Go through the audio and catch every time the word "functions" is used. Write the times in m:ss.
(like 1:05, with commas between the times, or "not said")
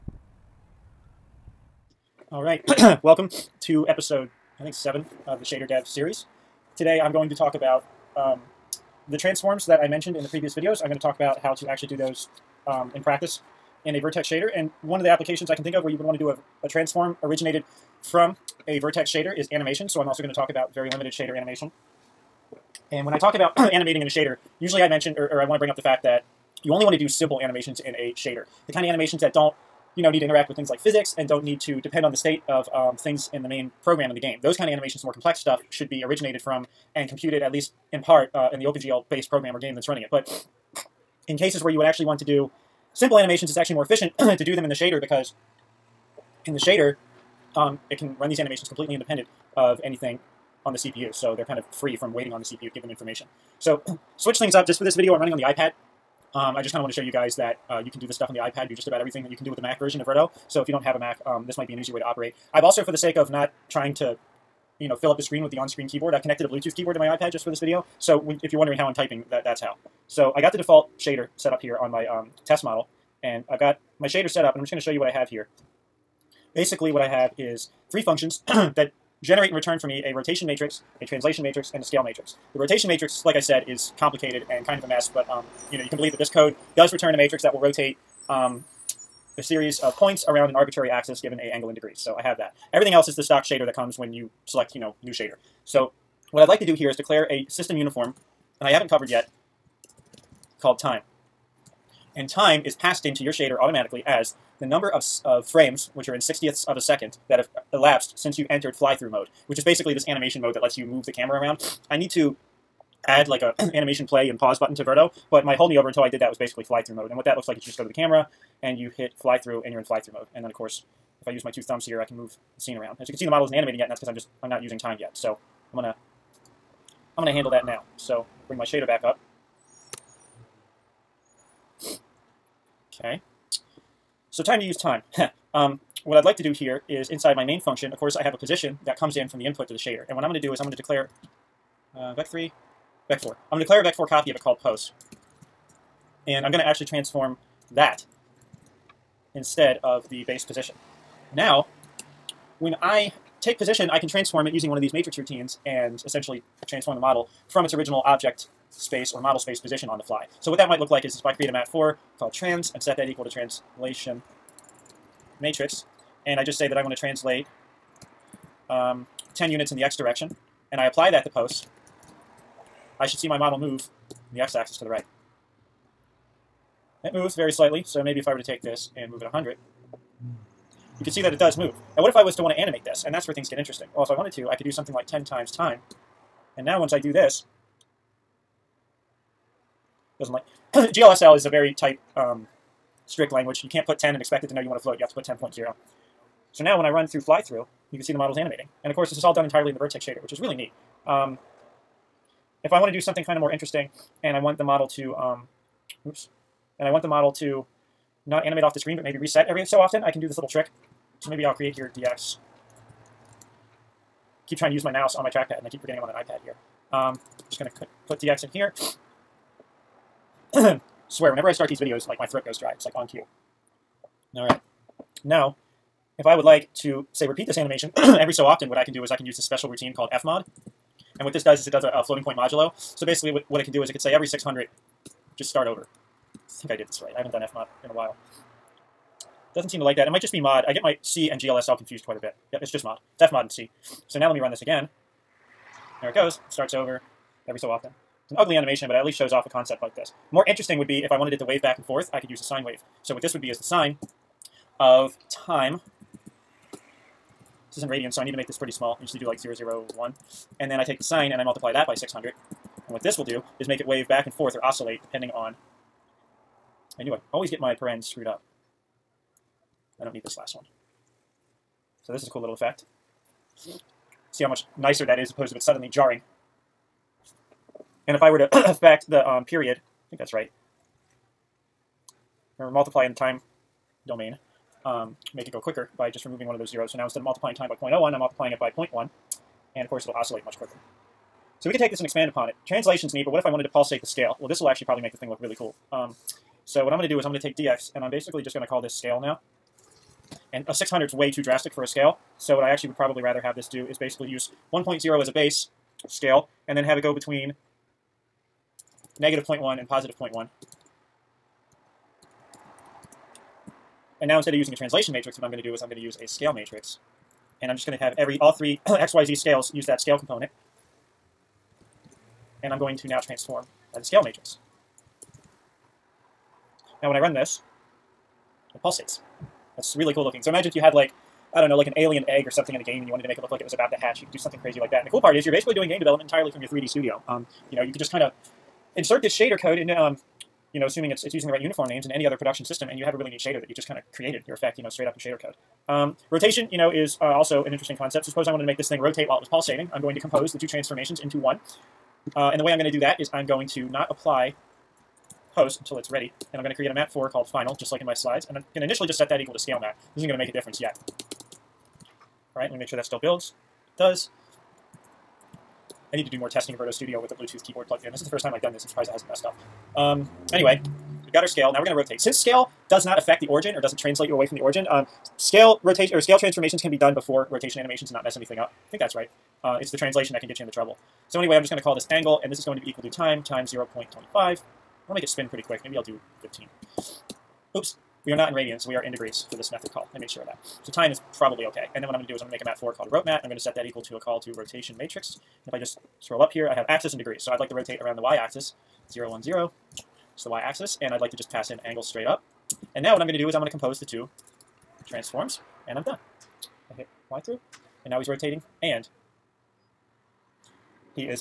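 1:18, 2:17.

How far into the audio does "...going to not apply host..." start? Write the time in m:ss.
5:53.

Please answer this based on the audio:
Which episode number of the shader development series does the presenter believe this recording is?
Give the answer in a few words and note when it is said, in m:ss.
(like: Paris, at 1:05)
7, at 0:04.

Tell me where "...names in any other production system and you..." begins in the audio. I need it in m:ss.
5:41.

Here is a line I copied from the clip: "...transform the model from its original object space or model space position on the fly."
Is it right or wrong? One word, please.
right.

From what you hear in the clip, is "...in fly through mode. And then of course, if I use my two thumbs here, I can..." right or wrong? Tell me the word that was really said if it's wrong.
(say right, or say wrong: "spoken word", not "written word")
right.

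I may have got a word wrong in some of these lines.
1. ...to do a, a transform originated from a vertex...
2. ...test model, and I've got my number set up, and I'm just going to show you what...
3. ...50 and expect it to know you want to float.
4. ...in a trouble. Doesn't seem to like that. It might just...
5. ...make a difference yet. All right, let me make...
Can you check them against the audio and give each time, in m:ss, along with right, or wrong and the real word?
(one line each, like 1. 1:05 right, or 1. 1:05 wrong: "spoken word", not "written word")
1. 0:16 right
2. 1:12 wrong: "shader", not "number"
3. 3:13 wrong: "10", not "50"
4. 3:57 wrong: "while", not "trouble"
5. 6:00 right.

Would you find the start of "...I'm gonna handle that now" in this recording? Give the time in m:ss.
2:07.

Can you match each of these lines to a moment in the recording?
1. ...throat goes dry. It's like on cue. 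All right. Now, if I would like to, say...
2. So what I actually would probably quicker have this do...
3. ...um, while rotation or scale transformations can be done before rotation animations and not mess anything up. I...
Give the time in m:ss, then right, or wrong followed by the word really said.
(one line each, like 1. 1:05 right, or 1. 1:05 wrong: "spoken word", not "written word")
1. 3:42 right
2. 5:02 wrong: "rather", not "quicker"
3. 6:14 wrong: "scale", not "while".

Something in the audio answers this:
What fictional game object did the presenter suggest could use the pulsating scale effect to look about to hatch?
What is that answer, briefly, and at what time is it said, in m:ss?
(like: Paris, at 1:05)
alien egg, at 5:31.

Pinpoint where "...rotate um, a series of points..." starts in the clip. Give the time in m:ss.
1:27.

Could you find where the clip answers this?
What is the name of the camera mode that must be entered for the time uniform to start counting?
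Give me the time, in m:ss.
1:48.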